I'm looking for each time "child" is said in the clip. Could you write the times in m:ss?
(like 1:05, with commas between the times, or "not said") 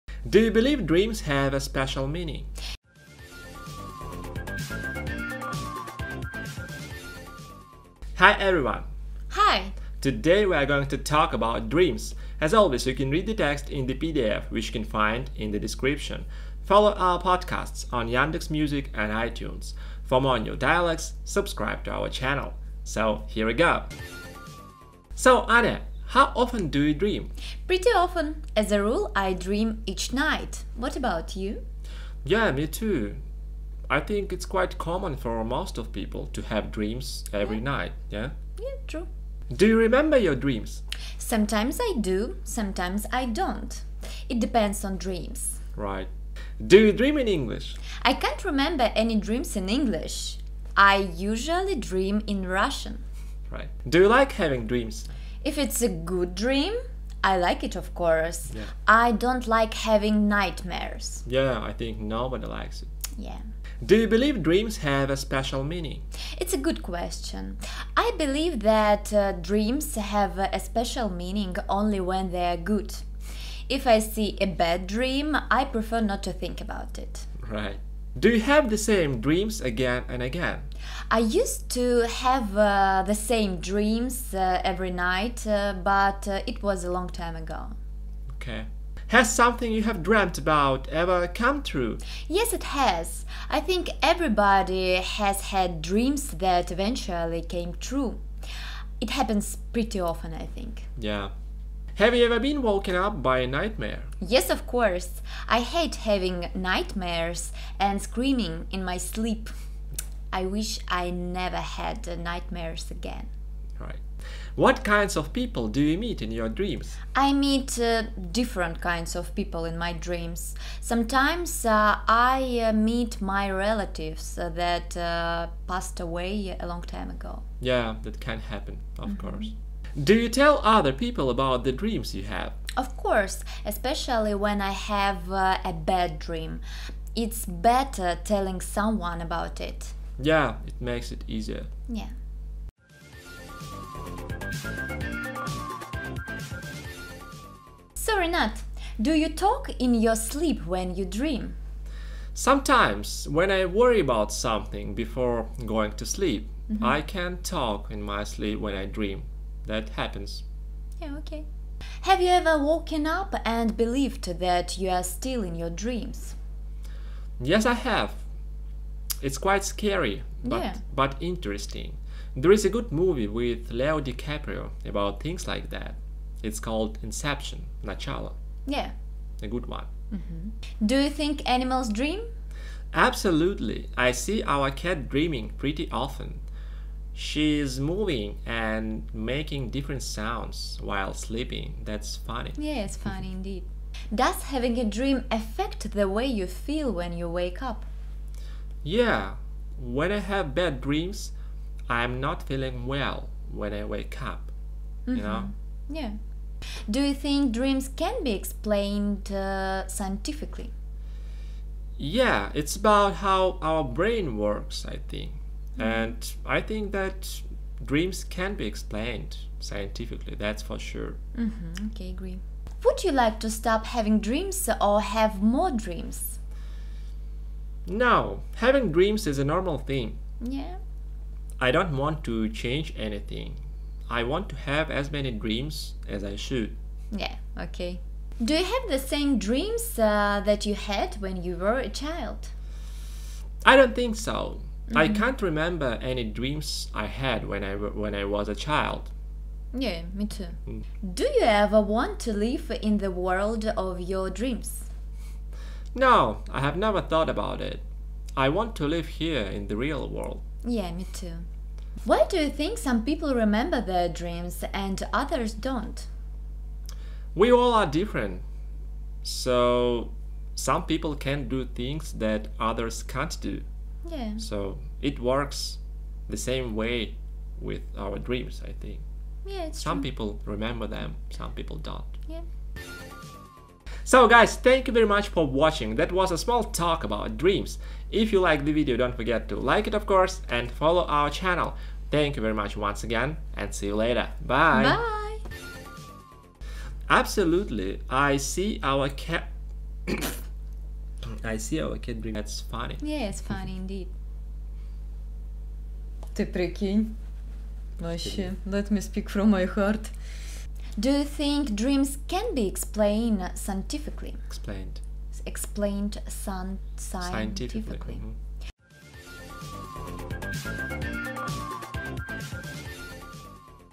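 4:01, 4:08.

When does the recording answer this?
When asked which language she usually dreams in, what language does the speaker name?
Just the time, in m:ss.
0:52.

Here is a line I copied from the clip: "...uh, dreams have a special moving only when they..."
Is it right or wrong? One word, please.
wrong.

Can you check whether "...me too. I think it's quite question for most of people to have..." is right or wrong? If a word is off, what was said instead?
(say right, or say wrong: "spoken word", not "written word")
wrong: "common", not "question".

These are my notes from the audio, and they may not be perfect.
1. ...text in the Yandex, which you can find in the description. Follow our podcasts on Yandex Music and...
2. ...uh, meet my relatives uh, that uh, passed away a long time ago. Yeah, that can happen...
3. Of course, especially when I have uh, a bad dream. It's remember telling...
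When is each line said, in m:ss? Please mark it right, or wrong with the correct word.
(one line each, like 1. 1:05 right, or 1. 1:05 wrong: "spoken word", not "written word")
1. 0:13 wrong: "PDF", not "Yandex"
2. 2:02 right
3. 2:12 wrong: "better", not "remember".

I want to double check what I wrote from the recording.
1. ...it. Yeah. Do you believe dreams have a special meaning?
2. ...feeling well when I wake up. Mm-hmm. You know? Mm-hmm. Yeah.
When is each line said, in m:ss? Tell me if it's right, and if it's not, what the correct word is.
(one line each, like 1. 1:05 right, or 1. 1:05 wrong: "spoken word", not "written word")
1. 1:02 right
2. 3:22 right.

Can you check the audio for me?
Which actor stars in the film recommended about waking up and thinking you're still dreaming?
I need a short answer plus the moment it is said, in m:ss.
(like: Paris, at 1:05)
Leo DiCaprio, at 2:53.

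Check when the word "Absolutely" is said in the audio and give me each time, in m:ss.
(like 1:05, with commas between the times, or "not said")
3:02, 4:57.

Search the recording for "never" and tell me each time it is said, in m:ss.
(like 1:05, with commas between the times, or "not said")
1:51, 4:16.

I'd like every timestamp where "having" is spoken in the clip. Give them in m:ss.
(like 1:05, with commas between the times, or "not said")
0:54, 0:59, 1:45, 3:14, 3:43, 3:48.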